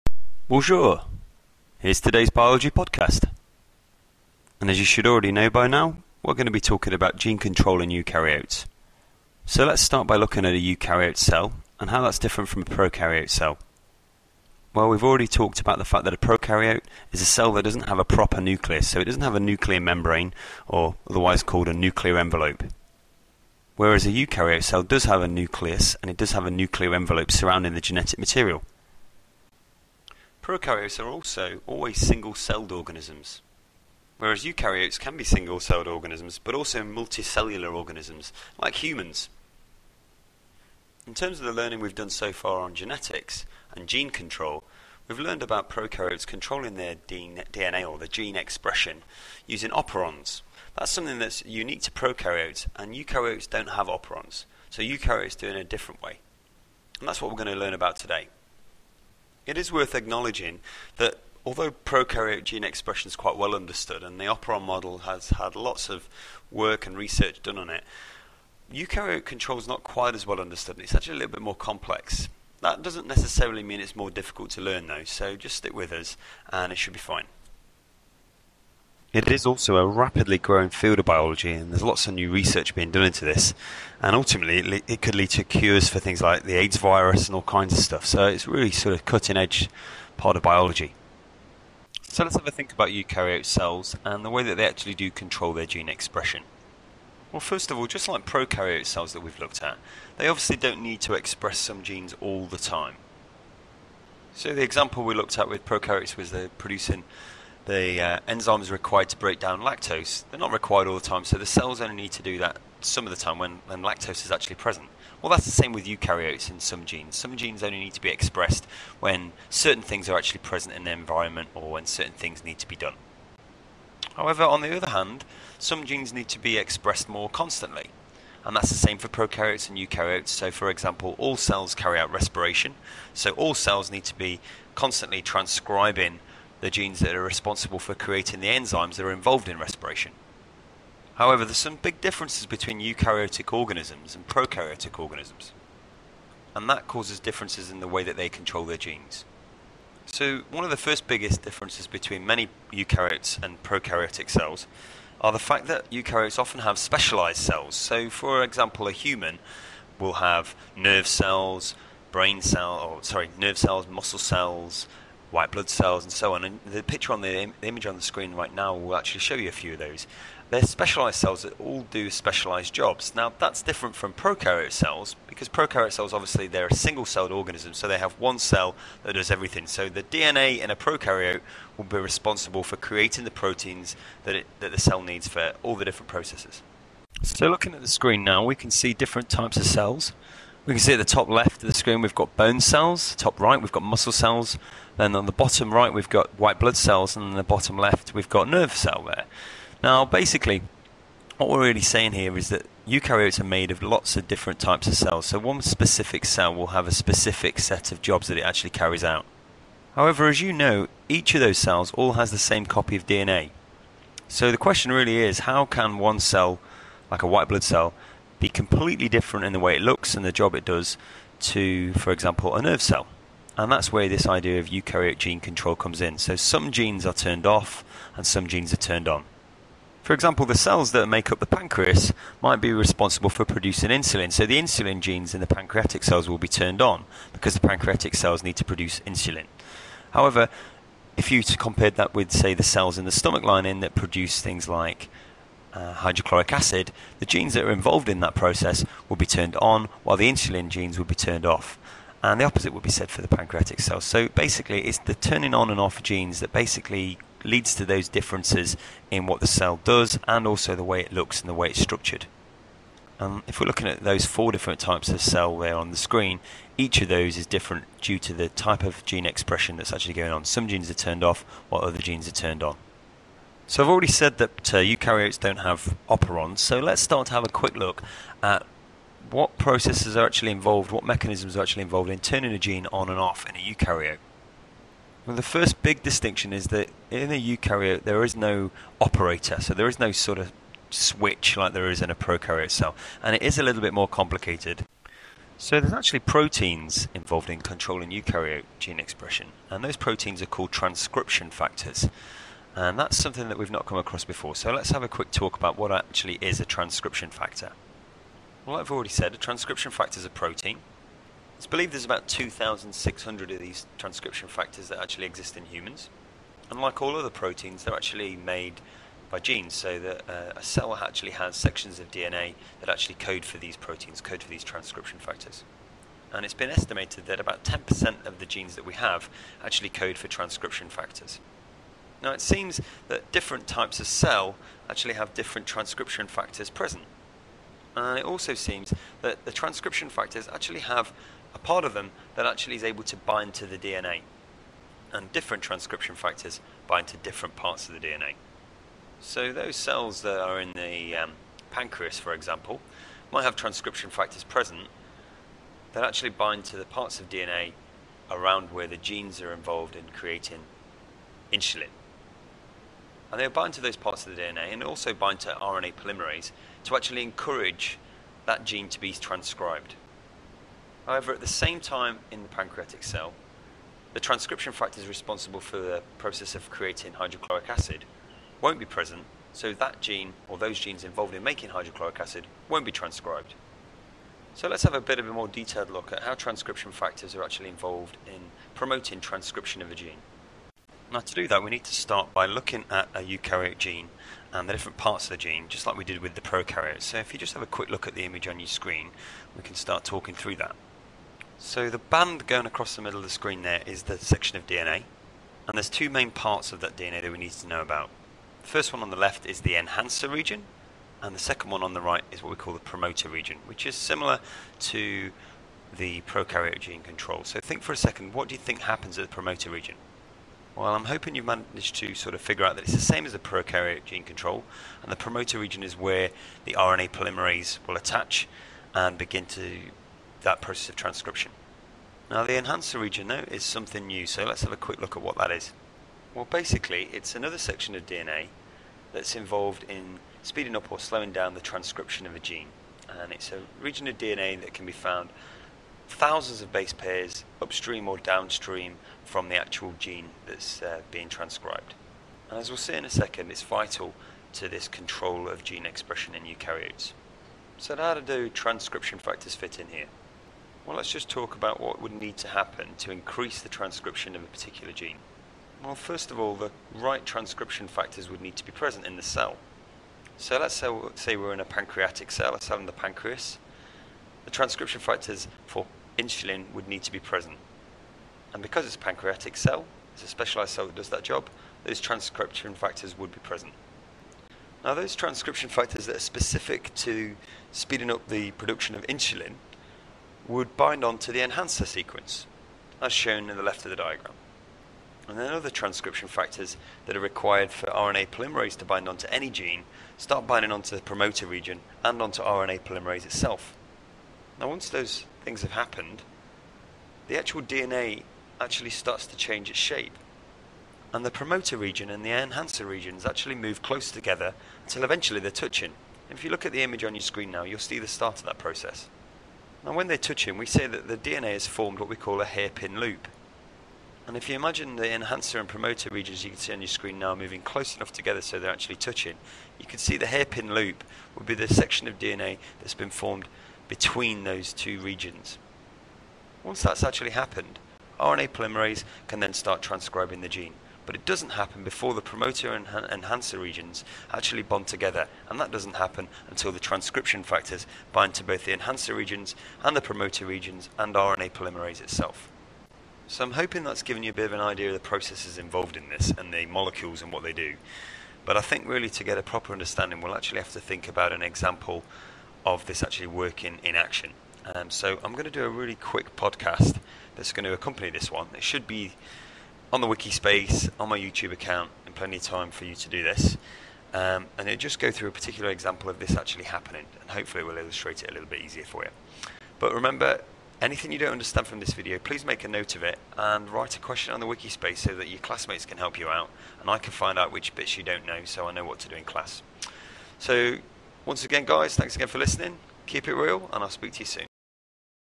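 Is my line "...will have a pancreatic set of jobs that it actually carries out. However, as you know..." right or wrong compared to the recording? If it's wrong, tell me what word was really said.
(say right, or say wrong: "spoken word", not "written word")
wrong: "specific", not "pancreatic".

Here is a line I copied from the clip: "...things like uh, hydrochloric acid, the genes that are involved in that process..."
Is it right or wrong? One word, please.
right.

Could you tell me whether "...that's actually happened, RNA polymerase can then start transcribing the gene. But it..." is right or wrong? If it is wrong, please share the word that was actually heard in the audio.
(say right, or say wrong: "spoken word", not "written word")
right.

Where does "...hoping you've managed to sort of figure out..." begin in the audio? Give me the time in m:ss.
7:01.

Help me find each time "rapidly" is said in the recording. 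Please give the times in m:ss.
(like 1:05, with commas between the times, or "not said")
1:19.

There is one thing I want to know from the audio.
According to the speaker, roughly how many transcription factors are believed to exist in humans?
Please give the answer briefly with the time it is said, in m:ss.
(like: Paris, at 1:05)
2,600, at 5:12.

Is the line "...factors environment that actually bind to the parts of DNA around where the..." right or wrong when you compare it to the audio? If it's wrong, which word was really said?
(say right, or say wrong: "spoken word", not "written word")
wrong: "present", not "environment".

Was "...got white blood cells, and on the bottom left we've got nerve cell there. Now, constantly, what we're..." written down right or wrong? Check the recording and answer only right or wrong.
wrong.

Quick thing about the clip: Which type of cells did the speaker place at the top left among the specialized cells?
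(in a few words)
bone cells.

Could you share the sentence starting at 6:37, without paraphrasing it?
So if you just have a quick look at the image on your screen, we can start talking through that.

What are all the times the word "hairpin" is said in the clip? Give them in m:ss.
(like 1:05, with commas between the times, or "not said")
8:42, 8:50.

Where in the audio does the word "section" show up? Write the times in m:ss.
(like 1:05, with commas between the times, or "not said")
5:21, 6:44, 7:17, 8:51.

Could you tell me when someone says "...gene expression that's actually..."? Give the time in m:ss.
4:29.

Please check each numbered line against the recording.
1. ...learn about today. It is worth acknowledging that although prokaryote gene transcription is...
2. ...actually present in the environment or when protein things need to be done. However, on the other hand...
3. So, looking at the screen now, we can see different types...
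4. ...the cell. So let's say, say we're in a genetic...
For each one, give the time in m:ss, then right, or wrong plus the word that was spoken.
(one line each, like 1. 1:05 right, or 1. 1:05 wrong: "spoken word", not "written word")
1. 0:57 wrong: "expression", not "transcription"
2. 2:00 wrong: "certain", not "protein"
3. 3:07 right
4. 7:49 wrong: "pancreatic", not "genetic".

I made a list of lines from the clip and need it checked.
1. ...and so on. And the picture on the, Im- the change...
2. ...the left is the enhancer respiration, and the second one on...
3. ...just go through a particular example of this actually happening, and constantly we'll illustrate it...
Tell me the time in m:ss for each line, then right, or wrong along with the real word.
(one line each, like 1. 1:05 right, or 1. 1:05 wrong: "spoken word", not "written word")
1. 2:46 wrong: "image", not "change"
2. 6:49 wrong: "region", not "respiration"
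3. 9:34 wrong: "hopefully", not "constantly".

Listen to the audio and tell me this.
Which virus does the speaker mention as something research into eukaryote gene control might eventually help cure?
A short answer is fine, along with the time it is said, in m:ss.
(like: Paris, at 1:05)
AIDS, at 1:26.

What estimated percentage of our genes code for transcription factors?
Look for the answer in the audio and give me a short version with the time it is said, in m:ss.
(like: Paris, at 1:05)
10%, at 5:27.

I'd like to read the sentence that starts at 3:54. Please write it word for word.
So the insulin genes in the pancreatic cells will be turned on because the pancreatic cells need to produce insulin.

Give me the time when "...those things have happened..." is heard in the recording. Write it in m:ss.
8:24.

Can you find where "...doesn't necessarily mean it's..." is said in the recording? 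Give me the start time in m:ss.
1:12.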